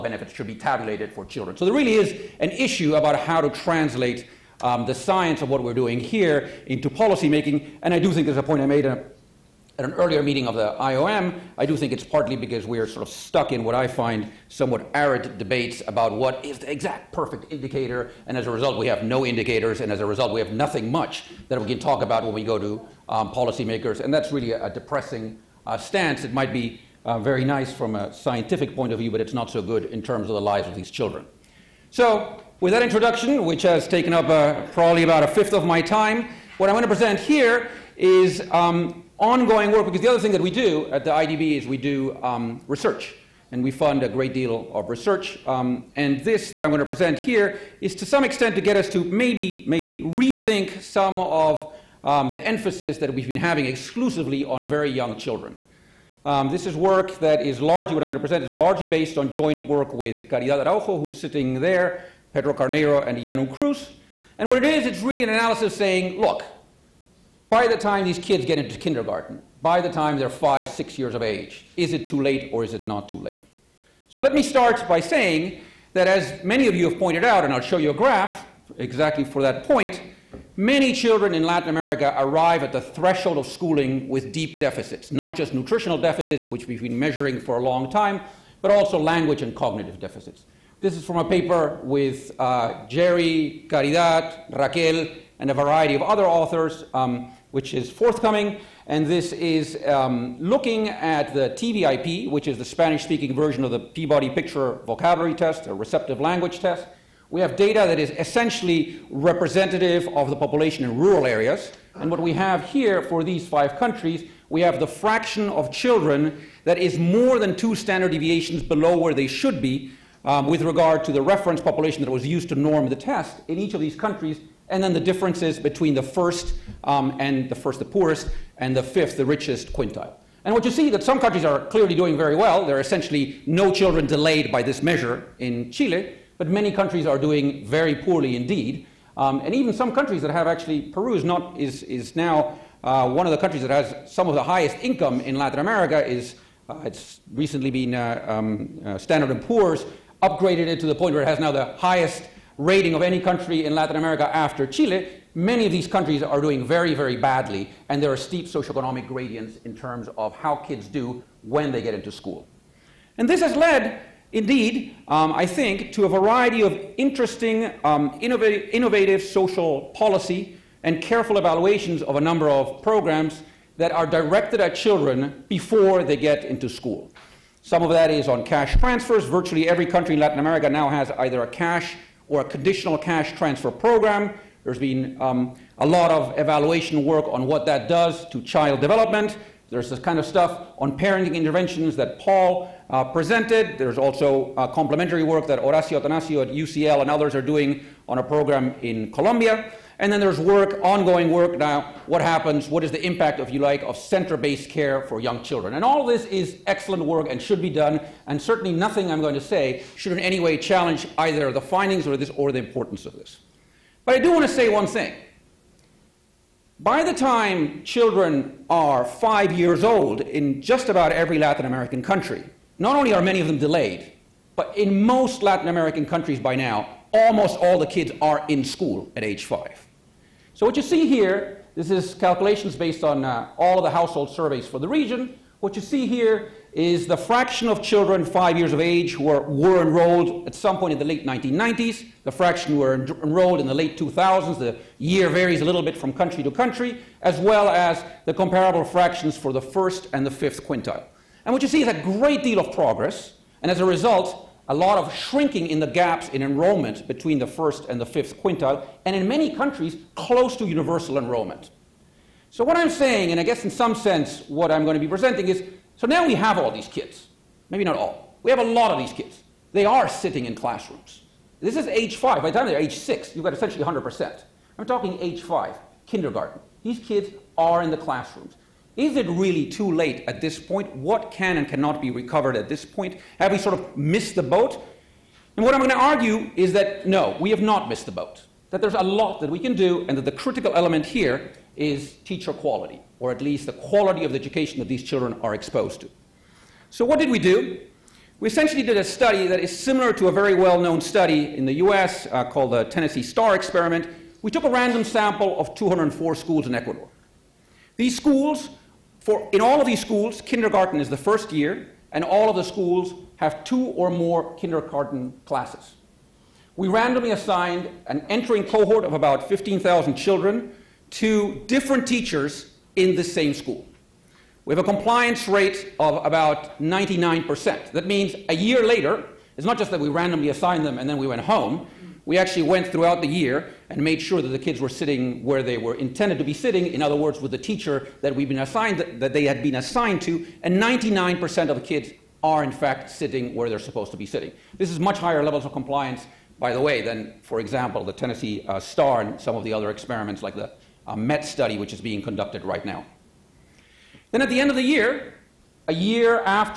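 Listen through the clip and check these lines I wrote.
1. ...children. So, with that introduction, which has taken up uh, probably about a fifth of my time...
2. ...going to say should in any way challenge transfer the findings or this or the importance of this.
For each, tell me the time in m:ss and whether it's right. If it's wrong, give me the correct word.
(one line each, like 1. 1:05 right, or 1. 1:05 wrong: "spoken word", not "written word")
1. 0:30 right
2. 3:29 wrong: "either", not "transfer".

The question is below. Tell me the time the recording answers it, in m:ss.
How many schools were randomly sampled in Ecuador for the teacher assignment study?
5:05.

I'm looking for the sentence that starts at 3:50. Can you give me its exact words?
So what you see here, this is calculations based on uh, all of the household surveys for the region.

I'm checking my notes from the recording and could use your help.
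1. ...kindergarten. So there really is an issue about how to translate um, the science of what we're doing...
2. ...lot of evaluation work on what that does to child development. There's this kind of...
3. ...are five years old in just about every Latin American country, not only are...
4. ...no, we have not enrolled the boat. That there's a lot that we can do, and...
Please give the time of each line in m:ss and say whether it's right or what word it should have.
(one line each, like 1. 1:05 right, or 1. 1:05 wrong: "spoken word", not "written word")
1. 0:01 wrong: "children", not "kindergarten"
2. 3:05 right
3. 3:38 right
4. 4:47 wrong: "missed", not "enrolled".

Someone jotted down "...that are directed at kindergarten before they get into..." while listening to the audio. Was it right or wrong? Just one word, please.
wrong.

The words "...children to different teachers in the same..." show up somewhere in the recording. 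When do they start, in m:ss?
5:20.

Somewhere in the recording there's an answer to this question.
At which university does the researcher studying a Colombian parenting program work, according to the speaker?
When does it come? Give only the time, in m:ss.
3:16.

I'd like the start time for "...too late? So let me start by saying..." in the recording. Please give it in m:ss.
1:13.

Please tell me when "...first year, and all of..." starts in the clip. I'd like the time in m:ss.
5:11.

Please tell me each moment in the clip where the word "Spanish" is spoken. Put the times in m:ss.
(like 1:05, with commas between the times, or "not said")
1:42.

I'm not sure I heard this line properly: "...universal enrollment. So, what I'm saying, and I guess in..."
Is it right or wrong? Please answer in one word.
right.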